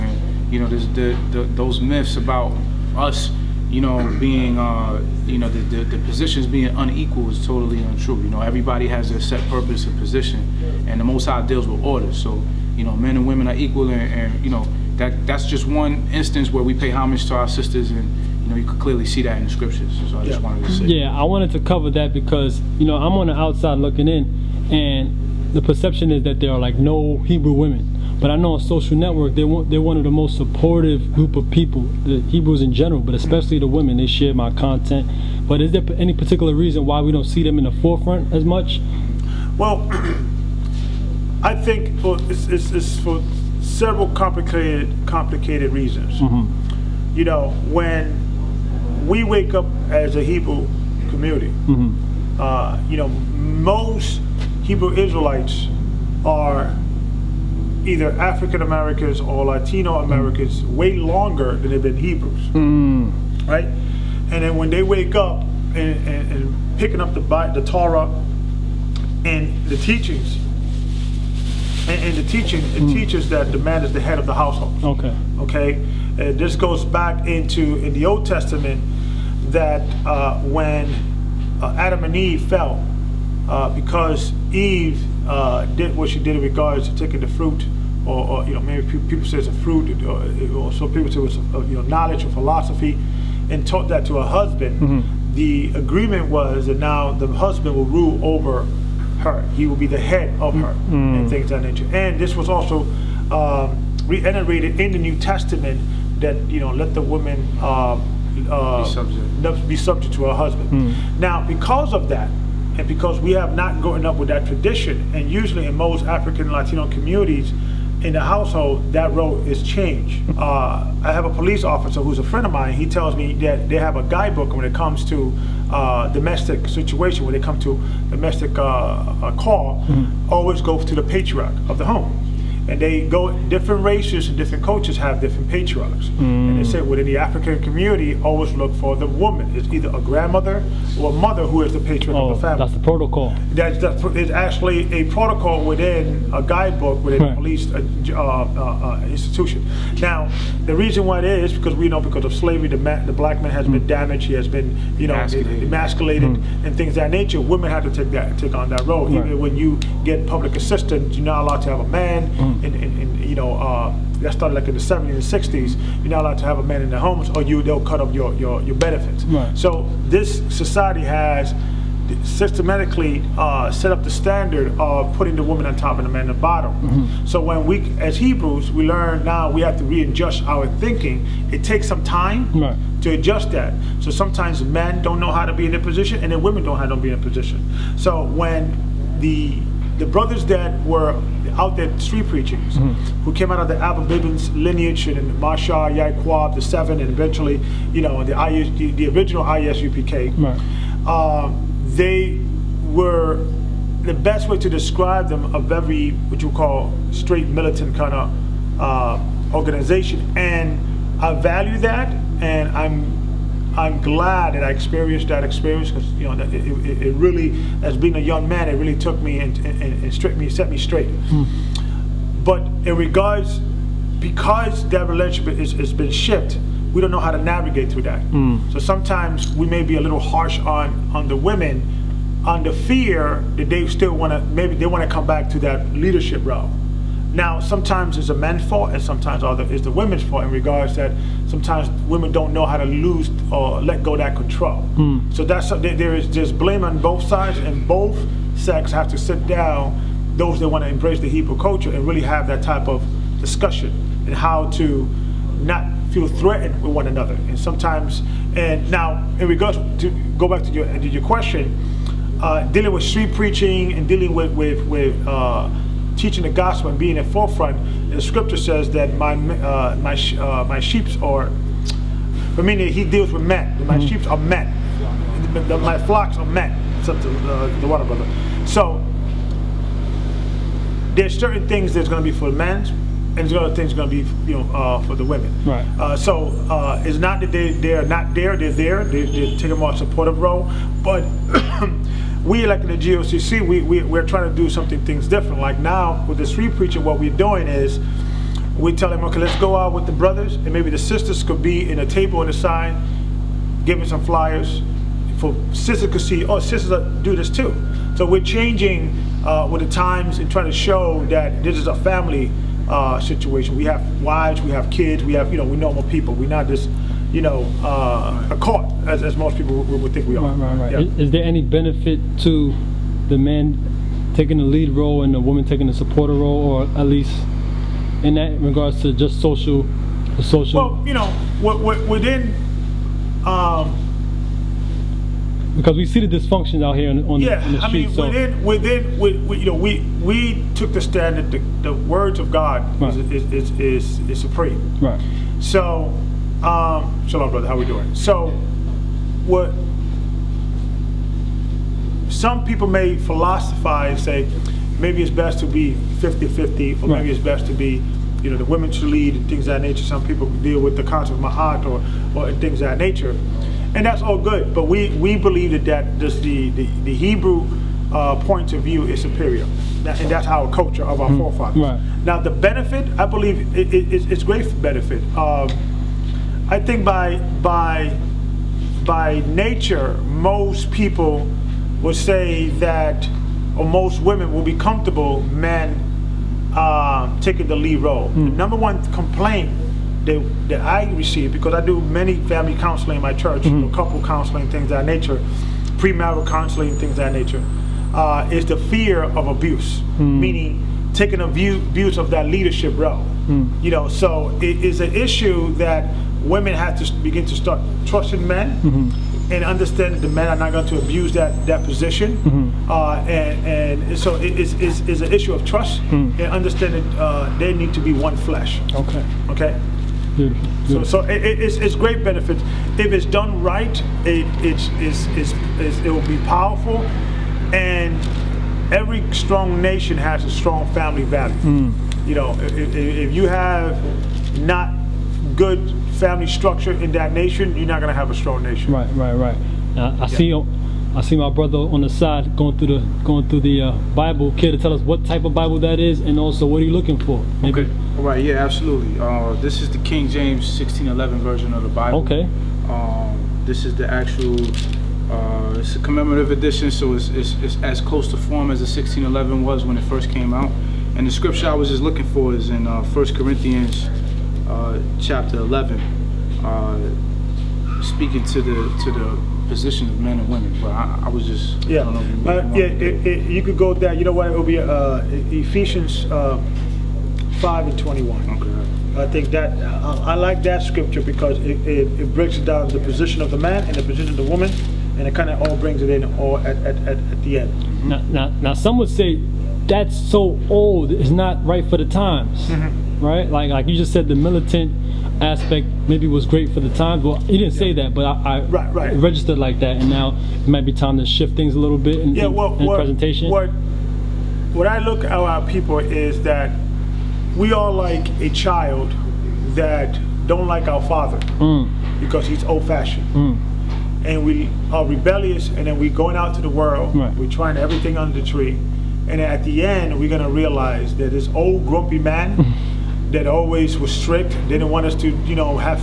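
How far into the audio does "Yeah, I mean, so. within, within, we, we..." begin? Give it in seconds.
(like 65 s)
338 s.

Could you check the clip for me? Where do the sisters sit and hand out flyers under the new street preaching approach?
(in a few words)
a table on the side.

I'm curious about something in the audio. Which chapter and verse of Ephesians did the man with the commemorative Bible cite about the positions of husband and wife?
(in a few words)
5:21.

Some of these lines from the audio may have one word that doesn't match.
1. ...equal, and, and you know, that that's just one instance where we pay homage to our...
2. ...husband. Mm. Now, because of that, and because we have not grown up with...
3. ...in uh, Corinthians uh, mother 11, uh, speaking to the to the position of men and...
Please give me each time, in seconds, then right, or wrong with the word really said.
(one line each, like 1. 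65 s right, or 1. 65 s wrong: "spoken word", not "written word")
1. 13 s right
2. 110 s right
3. 462 s wrong: "chapter", not "mother".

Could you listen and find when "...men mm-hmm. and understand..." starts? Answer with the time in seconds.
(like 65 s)
408 s.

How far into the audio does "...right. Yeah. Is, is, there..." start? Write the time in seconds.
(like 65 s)
320 s.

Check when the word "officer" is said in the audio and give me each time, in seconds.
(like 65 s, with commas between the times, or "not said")
121 s.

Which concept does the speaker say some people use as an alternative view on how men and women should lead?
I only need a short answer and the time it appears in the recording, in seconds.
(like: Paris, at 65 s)
Ma'at, at 361 s.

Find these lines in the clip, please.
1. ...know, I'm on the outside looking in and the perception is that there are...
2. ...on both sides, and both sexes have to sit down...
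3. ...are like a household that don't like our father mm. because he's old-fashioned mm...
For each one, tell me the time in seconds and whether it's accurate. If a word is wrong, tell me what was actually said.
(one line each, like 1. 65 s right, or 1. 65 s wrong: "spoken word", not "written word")
1. 22 s right
2. 246 s right
3. 507 s wrong: "child", not "household".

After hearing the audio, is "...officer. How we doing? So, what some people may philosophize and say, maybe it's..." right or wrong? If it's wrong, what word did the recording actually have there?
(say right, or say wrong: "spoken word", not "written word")
wrong: "brother", not "officer".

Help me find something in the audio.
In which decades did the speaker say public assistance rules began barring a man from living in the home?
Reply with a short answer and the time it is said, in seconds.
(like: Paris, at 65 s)
70s and 60s, at 164 s.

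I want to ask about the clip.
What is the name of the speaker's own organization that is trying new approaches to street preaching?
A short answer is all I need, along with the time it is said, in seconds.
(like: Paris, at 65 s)
GOCC, at 292 s.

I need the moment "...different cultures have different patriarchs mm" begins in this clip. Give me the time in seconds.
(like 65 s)
134 s.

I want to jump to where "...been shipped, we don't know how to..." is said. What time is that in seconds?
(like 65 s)
225 s.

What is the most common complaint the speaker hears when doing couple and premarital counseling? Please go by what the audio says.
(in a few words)
fear of abuse.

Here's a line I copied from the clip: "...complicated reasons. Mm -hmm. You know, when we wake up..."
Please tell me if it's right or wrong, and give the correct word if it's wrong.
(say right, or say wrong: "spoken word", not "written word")
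right.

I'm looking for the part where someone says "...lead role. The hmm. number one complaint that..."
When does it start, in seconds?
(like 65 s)
387 s.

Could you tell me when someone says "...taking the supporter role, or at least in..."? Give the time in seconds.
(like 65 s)
325 s.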